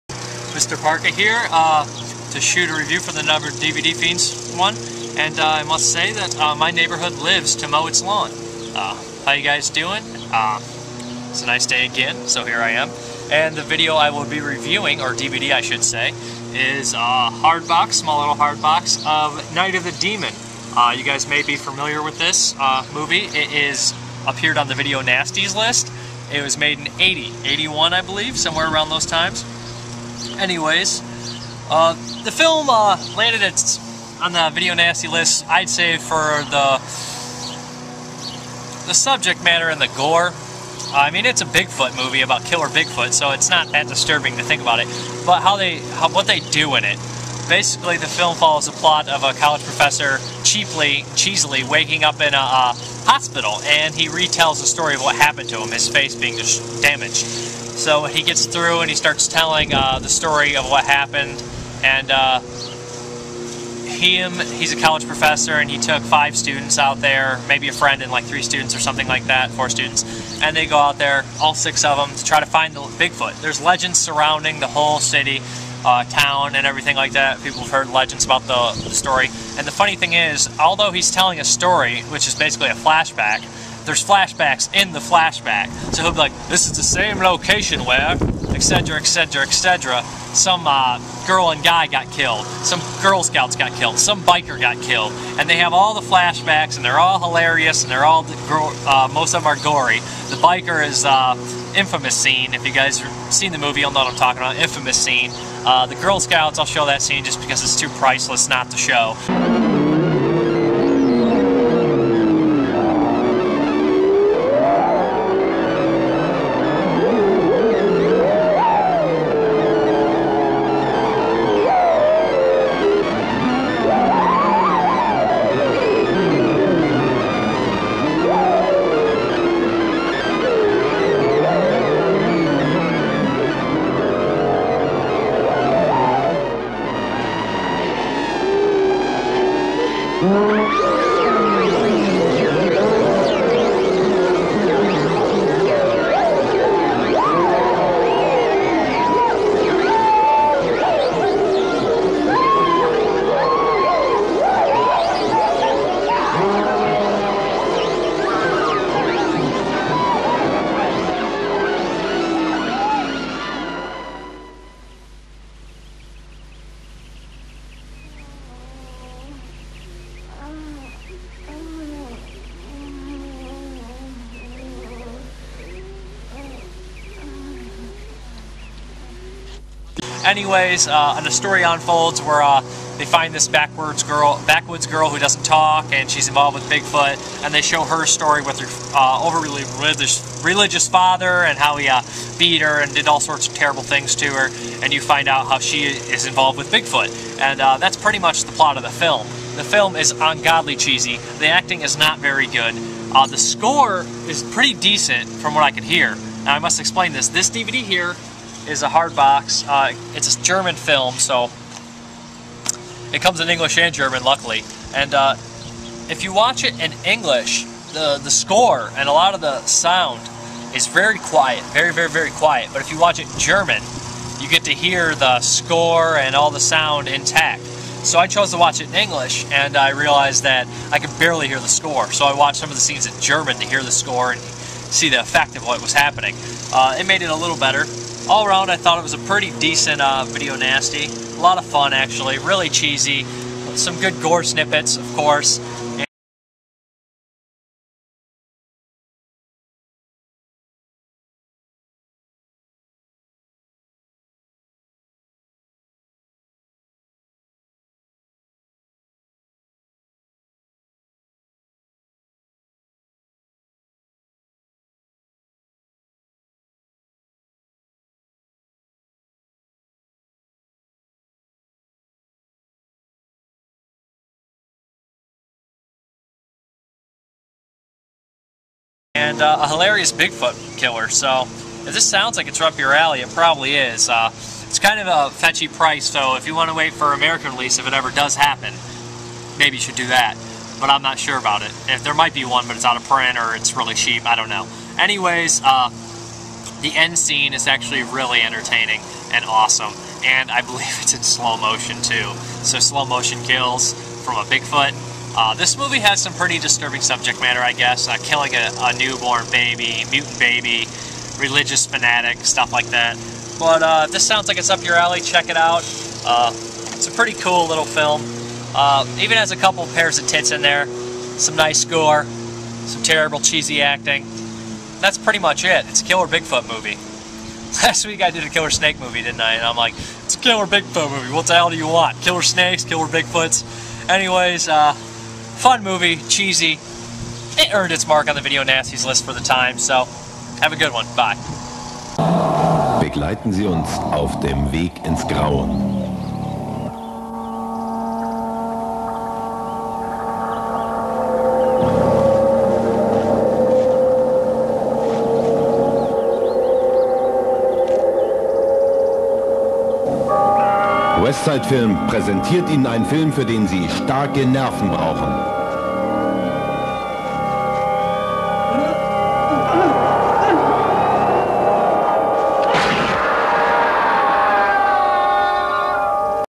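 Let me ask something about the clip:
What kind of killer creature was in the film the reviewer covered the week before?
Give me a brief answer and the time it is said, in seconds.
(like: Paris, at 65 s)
Killer snake, at 328 s.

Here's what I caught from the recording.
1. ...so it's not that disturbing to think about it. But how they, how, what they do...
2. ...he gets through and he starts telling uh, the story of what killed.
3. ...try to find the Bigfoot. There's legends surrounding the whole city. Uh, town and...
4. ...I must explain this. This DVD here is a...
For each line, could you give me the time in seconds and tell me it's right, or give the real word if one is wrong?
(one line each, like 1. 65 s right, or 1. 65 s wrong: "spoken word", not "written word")
1. 43 s right
2. 58 s wrong: "happened", not "killed"
3. 72 s right
4. 206 s right.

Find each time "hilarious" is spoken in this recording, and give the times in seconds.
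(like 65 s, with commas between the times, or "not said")
97 s, 279 s.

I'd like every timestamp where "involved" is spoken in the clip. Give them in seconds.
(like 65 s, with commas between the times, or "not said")
186 s, 196 s.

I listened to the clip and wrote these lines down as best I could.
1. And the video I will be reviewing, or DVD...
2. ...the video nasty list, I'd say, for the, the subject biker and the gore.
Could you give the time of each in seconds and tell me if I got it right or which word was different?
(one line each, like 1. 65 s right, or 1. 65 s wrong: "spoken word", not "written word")
1. 13 s right
2. 34 s wrong: "matter", not "biker".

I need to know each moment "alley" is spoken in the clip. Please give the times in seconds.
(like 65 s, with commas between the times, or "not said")
282 s, 314 s.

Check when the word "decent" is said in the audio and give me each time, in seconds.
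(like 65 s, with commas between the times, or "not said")
204 s, 239 s.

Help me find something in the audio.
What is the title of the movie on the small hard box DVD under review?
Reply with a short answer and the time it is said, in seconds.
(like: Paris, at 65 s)
Night of the Demon, at 19 s.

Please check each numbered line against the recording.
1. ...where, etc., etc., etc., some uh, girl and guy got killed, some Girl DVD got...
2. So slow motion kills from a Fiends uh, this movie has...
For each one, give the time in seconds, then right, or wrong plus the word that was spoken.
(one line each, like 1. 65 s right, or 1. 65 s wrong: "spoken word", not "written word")
1. 87 s wrong: "Scouts", not "DVD"
2. 302 s wrong: "Bigfoot", not "Fiends".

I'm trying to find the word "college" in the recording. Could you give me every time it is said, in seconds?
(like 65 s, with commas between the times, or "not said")
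49 s, 64 s.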